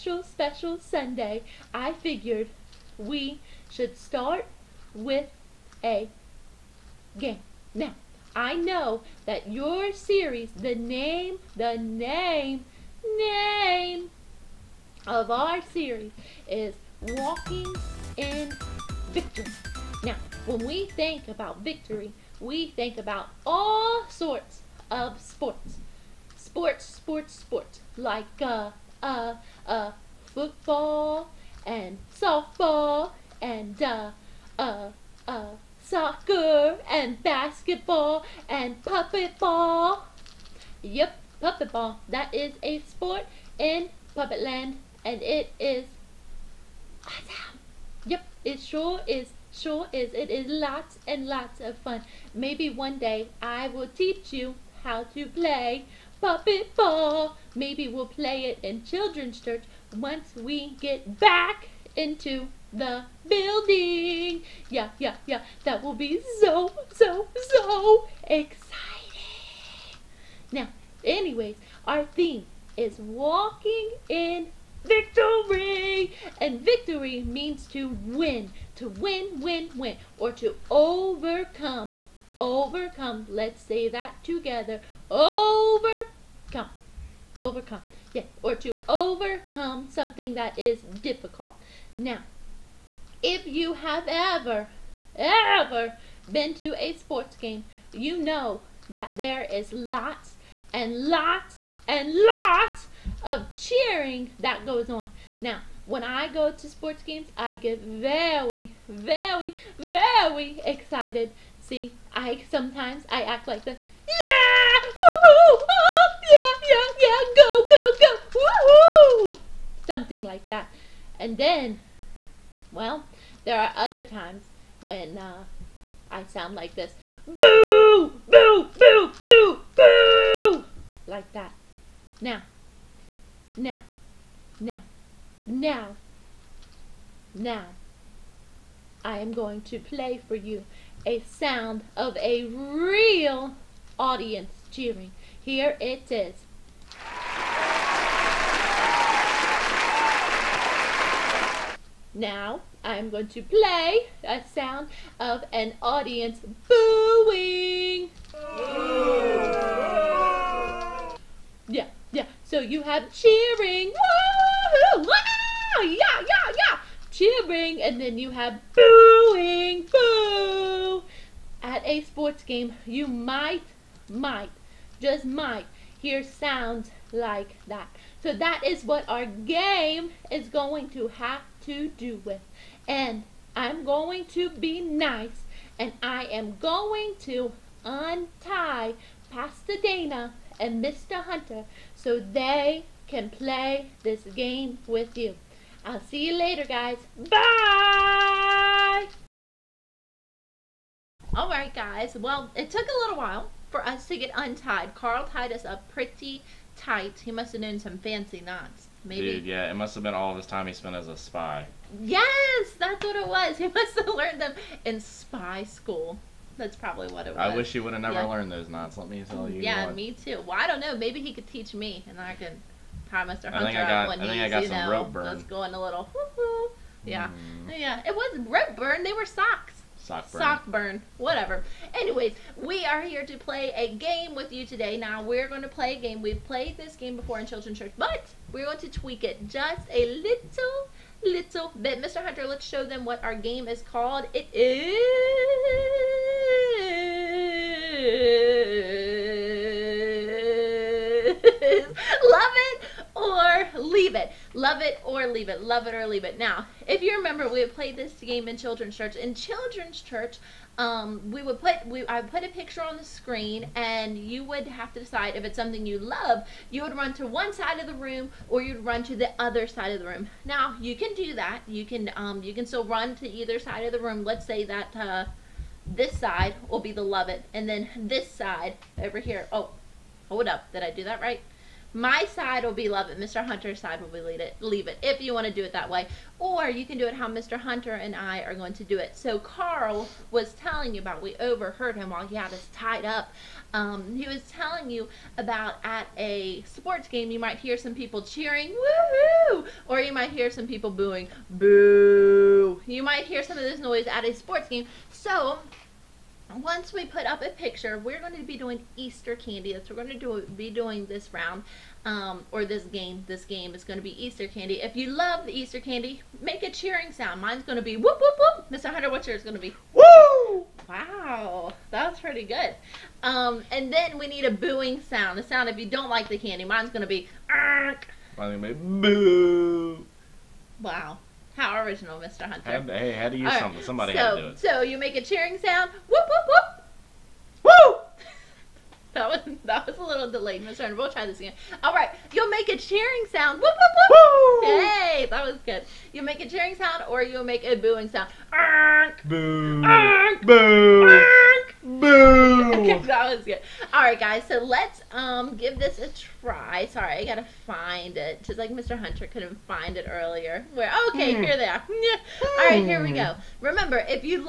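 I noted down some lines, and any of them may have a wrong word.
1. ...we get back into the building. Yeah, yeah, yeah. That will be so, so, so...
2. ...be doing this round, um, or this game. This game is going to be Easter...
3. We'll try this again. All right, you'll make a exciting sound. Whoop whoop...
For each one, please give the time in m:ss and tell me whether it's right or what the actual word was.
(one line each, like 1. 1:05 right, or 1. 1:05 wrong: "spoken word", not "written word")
1. 1:00 right
2. 5:10 right
3. 5:40 wrong: "cheering", not "exciting".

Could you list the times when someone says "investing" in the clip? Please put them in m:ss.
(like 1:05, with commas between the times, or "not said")
not said.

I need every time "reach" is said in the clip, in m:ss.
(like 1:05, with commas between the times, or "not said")
not said.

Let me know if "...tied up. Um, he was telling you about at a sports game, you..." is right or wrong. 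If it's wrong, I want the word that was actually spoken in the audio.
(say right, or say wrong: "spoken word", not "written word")
right.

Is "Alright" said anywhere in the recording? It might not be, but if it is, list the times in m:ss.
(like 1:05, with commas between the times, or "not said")
3:21.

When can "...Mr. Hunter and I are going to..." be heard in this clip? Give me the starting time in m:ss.
4:47.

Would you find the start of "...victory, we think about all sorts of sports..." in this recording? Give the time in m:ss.
0:21.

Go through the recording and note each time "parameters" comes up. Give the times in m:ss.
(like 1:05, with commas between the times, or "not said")
not said.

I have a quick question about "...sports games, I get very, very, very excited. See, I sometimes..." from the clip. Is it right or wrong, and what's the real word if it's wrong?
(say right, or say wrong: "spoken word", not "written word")
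right.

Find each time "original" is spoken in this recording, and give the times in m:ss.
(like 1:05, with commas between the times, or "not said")
5:31.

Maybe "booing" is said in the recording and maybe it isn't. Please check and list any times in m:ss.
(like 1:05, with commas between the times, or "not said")
2:36, 2:48, 5:00, 5:24, 5:47.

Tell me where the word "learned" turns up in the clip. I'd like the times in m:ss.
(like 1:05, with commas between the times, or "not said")
3:34, 3:38.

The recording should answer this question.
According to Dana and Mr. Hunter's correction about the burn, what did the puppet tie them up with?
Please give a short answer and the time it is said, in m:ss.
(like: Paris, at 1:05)
Socks, at 3:49.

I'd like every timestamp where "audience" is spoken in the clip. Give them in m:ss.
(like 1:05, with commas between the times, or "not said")
2:23, 2:35.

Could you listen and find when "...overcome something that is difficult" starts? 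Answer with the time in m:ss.
1:28.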